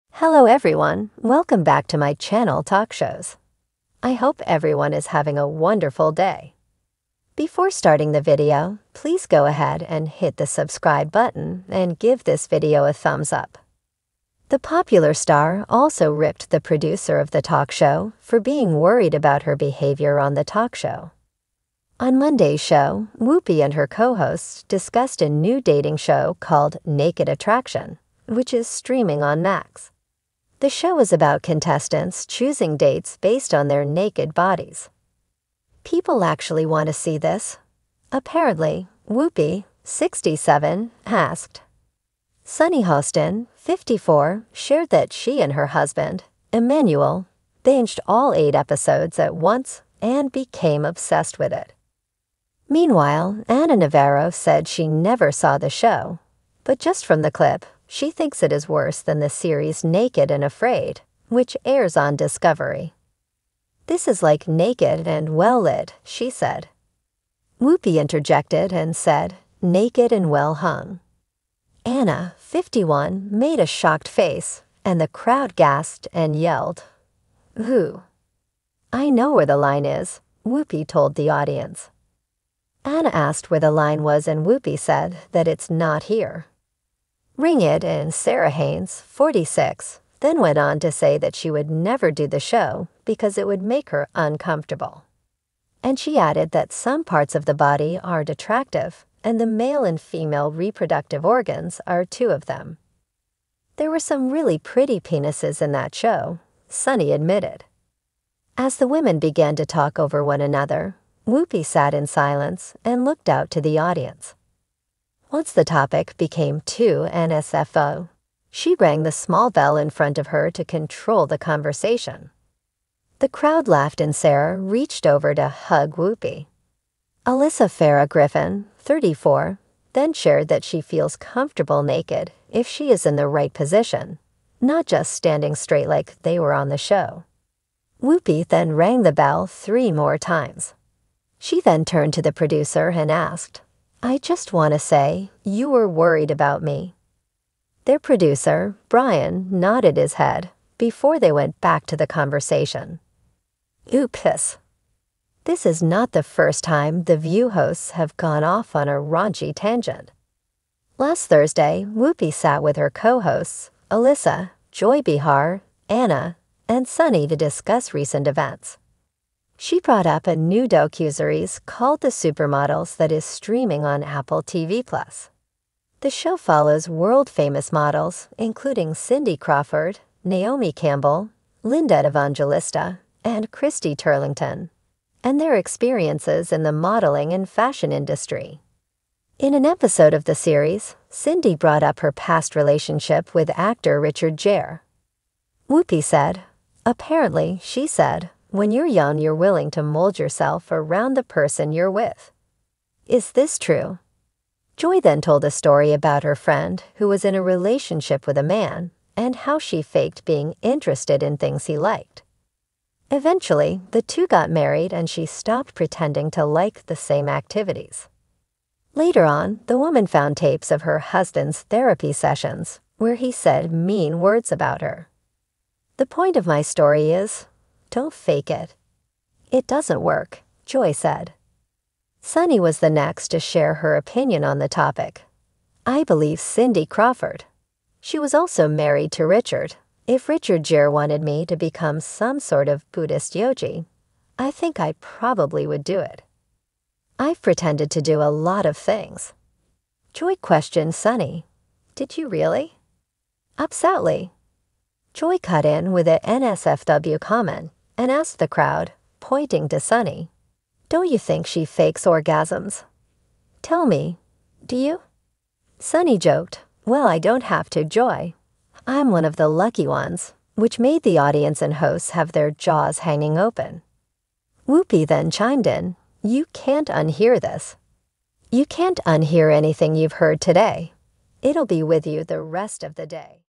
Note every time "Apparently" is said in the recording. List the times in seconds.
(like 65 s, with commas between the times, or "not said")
38 s, 196 s.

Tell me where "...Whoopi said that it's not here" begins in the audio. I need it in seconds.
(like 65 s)
84 s.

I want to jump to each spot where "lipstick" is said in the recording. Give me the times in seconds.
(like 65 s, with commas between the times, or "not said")
not said.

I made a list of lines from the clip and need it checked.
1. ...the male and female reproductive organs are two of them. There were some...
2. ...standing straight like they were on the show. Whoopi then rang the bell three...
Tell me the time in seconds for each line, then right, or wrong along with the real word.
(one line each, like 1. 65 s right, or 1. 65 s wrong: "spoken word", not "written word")
1. 99 s right
2. 135 s right.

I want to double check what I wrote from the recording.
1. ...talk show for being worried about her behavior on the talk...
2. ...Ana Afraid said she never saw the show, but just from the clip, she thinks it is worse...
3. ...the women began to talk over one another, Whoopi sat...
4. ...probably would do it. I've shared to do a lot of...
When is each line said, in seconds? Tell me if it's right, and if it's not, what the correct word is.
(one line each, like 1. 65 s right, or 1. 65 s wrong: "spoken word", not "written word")
1. 17 s right
2. 53 s wrong: "Navarro", not "Afraid"
3. 108 s right
4. 245 s wrong: "pretended", not "shared".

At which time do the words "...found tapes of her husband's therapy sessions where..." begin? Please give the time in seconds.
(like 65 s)
220 s.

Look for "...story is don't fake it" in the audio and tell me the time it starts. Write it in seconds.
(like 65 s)
226 s.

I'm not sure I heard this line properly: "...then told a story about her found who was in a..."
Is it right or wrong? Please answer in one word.
wrong.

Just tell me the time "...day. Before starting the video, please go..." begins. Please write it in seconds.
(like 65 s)
6 s.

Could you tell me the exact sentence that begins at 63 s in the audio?
This is like Naked and Well Lit, she said.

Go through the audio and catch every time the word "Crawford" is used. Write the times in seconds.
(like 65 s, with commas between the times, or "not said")
179 s, 236 s.